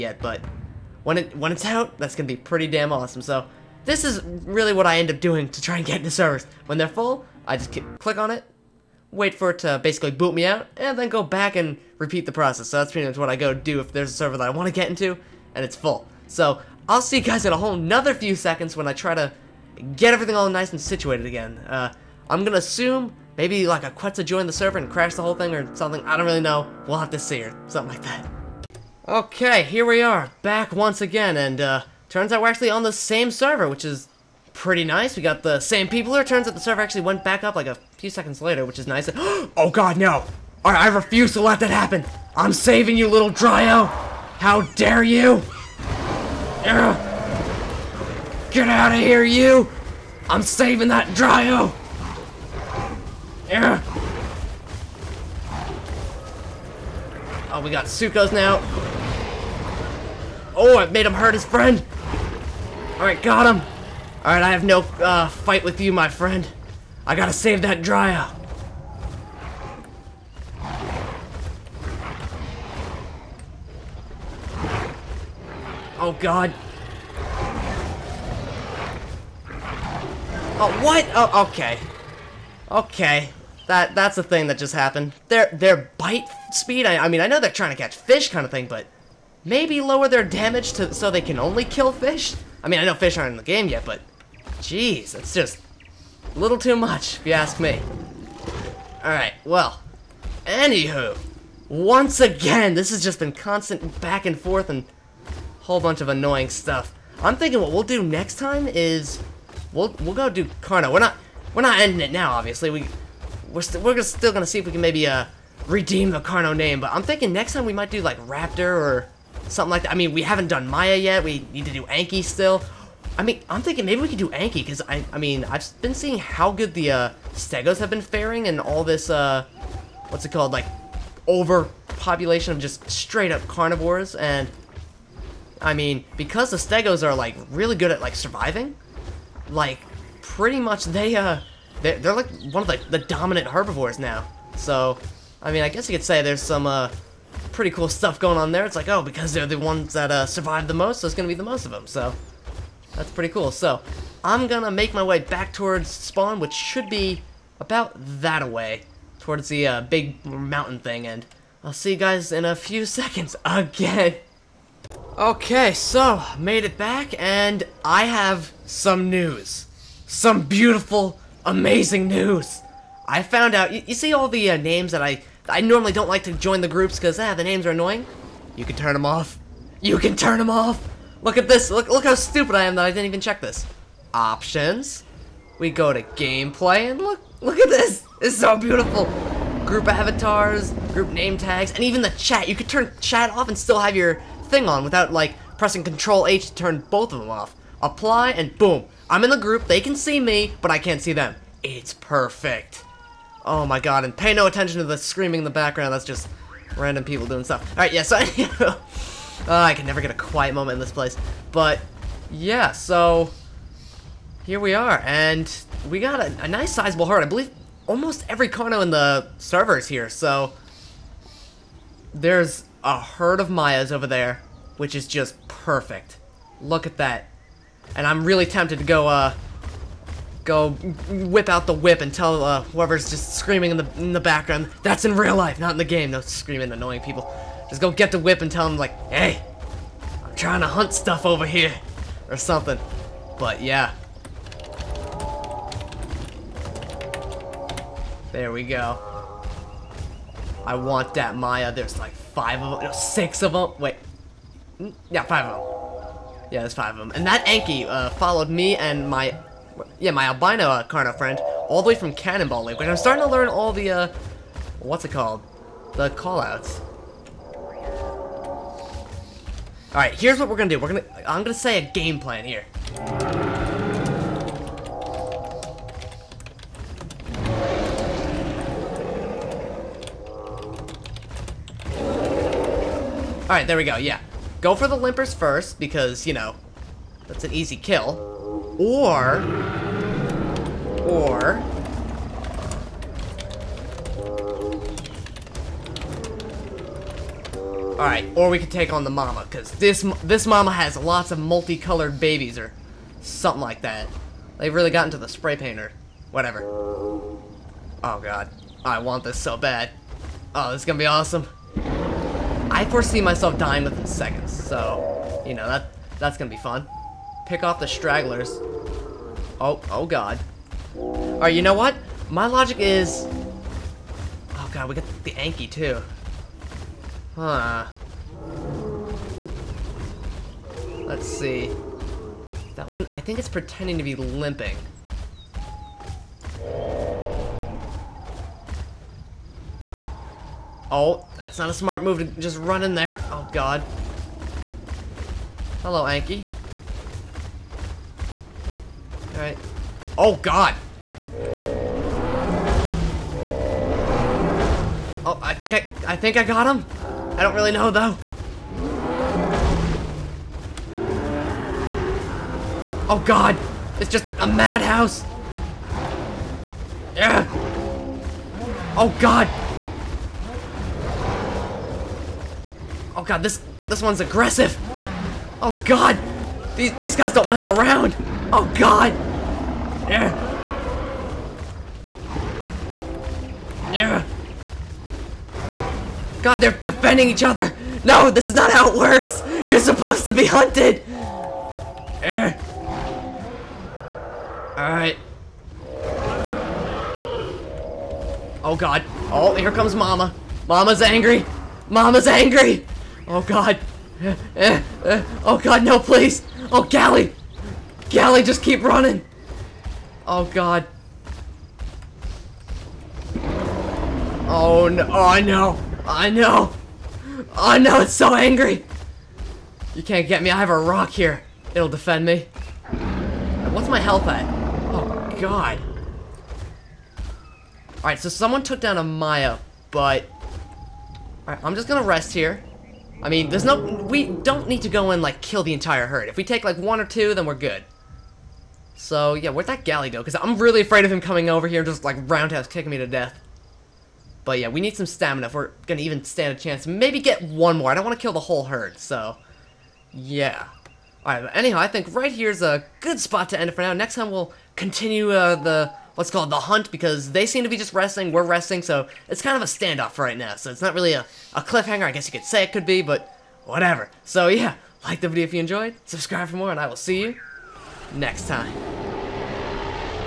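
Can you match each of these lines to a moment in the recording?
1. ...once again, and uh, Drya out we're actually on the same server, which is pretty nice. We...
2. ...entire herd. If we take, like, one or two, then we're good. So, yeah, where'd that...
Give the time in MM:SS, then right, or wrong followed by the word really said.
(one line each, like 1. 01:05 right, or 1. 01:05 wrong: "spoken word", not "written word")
1. 00:30 wrong: "Turns", not "Drya"
2. 07:15 right.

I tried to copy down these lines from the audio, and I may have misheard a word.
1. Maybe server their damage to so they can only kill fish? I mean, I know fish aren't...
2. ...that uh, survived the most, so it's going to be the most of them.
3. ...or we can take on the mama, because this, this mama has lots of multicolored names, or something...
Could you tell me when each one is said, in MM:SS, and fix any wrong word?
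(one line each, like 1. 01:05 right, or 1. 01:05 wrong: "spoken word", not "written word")
1. 01:29 wrong: "lower", not "server"
2. 02:29 right
3. 04:58 wrong: "babies", not "names".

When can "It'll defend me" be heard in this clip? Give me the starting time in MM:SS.
07:01.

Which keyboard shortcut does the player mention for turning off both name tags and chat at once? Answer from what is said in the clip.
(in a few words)
Control H.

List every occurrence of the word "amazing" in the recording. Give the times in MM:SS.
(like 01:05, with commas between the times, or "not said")
02:51.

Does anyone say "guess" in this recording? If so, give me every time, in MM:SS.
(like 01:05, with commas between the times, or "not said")
02:25, 07:42.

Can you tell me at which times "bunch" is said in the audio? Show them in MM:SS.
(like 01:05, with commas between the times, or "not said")
01:45.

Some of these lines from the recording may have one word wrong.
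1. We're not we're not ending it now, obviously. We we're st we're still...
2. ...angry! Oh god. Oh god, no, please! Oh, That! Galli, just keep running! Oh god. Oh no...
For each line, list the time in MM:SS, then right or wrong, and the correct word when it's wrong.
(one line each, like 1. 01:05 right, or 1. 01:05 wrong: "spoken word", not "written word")
1. 01:50 right
2. 06:42 wrong: "Galli", not "That".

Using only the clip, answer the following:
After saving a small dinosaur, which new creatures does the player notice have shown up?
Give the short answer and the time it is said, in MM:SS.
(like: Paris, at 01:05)
Suchos, at 00:57.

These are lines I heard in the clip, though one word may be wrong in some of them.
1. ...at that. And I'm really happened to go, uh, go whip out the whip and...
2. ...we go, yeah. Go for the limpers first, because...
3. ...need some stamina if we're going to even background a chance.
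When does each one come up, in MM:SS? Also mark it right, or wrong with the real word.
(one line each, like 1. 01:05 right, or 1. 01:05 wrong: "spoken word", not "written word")
1. 03:46 wrong: "tempted", not "happened"
2. 04:43 right
3. 07:24 wrong: "stand", not "background".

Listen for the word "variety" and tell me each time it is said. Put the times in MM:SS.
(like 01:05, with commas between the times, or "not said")
not said.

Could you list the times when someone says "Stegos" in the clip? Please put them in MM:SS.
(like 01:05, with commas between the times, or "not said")
02:07, 02:16.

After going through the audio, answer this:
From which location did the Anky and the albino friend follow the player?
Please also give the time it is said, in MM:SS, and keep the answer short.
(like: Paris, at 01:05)
Cannonball Lake, at 04:22.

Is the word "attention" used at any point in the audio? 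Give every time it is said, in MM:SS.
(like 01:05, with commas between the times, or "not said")
03:24.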